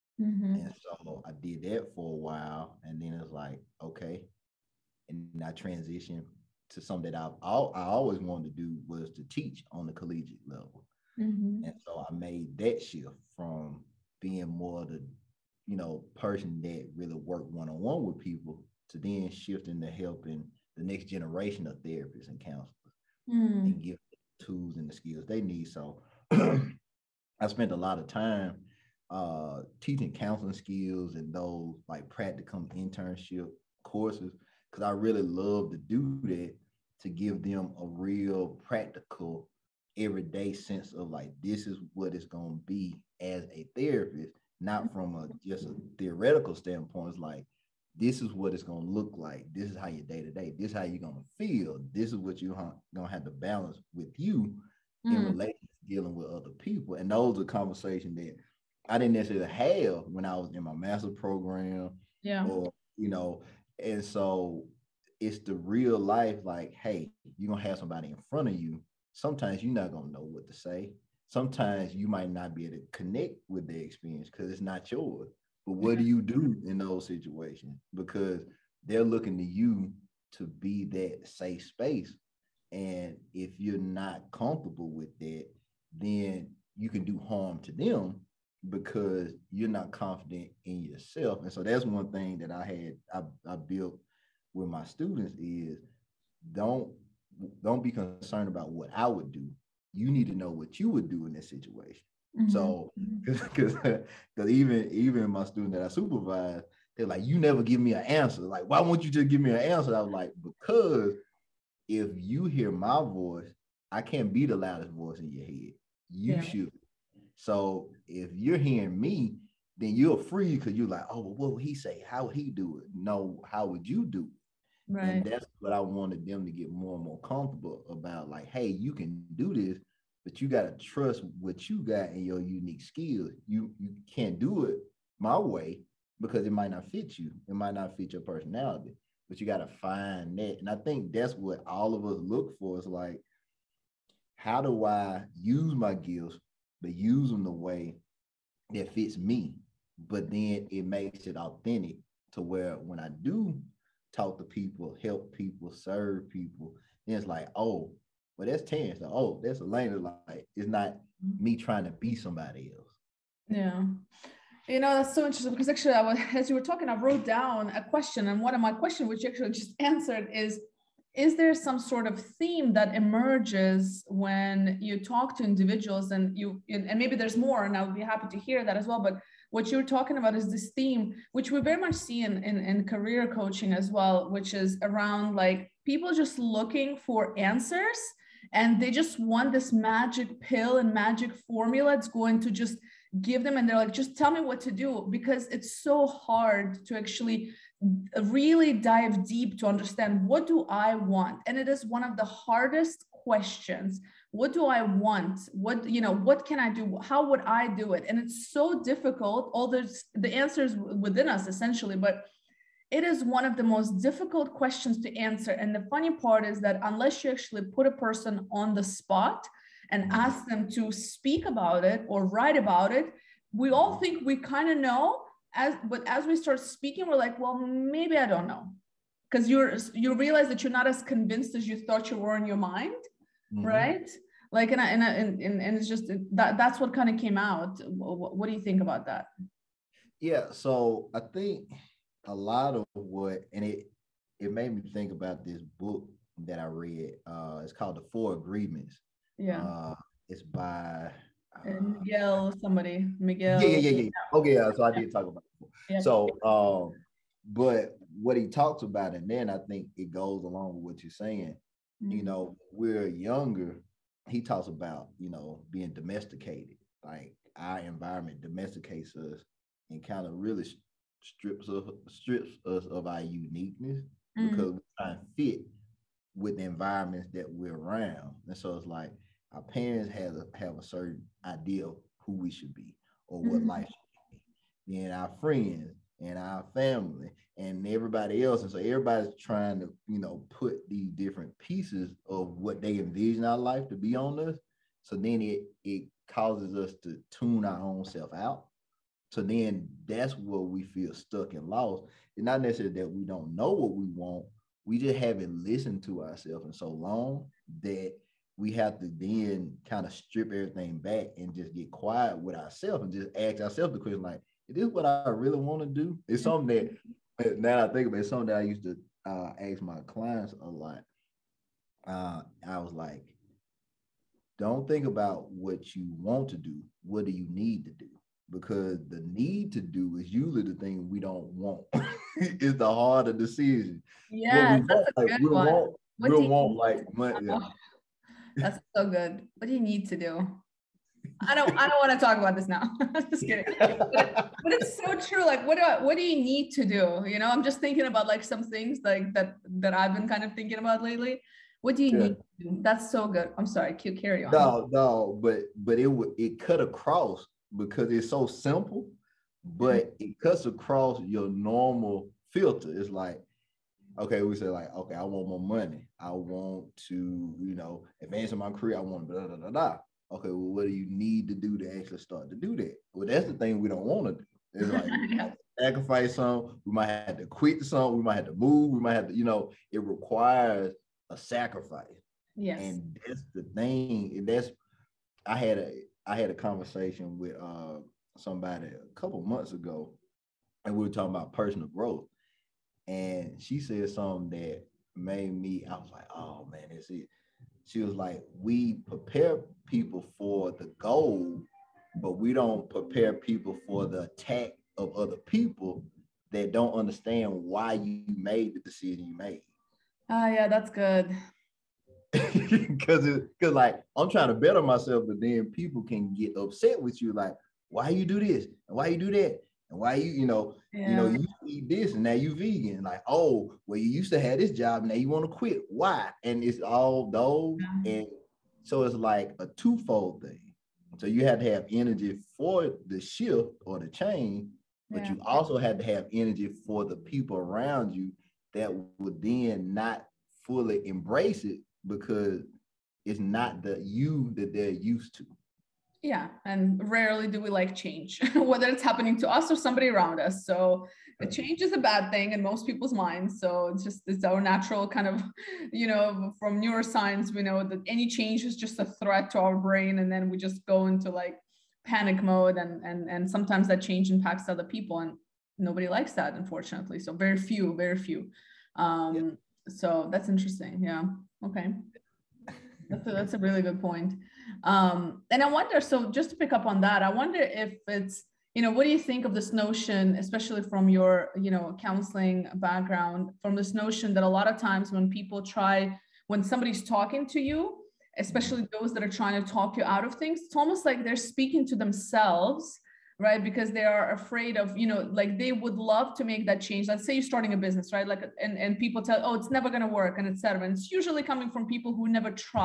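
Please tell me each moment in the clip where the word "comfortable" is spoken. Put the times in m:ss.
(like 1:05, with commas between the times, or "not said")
1:24, 2:07.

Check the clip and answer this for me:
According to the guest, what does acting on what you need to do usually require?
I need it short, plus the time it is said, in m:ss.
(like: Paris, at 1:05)
a sacrifice, at 6:21.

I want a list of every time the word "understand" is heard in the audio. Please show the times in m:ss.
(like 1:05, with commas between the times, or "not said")
3:19, 6:46.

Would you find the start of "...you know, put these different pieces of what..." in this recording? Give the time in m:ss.
4:50.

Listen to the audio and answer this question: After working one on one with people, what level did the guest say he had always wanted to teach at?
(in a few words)
collegiate level.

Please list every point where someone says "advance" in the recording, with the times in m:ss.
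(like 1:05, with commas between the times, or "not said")
6:08.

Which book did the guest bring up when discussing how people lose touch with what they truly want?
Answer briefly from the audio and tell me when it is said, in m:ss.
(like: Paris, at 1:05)
The Four Agreements, at 4:07.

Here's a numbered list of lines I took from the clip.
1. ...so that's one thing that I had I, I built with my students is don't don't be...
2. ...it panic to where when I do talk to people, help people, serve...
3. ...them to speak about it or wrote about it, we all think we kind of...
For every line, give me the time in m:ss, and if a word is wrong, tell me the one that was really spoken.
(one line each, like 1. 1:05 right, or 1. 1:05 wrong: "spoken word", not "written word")
1. 1:31 right
2. 2:31 wrong: "authentic", not "panic"
3. 3:40 wrong: "write", not "wrote".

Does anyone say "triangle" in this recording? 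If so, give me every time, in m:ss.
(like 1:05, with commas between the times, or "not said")
not said.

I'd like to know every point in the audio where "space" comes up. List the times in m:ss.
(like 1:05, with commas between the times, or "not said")
1:21.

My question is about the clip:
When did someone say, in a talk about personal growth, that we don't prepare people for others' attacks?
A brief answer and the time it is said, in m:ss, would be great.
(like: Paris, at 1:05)
a couple months ago, at 6:28.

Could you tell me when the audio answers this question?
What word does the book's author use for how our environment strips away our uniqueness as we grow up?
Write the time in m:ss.
4:25.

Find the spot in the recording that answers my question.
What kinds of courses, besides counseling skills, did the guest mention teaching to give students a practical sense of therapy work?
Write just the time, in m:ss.
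0:32.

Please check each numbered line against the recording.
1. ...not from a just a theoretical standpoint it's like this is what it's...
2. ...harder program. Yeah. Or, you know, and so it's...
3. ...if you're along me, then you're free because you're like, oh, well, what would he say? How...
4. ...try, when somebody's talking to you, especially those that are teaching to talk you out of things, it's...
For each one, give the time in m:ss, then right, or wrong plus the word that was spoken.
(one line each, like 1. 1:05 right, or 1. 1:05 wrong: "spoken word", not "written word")
1. 0:44 right
2. 1:00 wrong: "master", not "harder"
3. 1:58 wrong: "hearing", not "along"
4. 8:05 wrong: "trying", not "teaching".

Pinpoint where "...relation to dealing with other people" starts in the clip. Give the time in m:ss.
0:55.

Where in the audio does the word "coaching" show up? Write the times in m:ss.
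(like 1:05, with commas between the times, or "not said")
3:03.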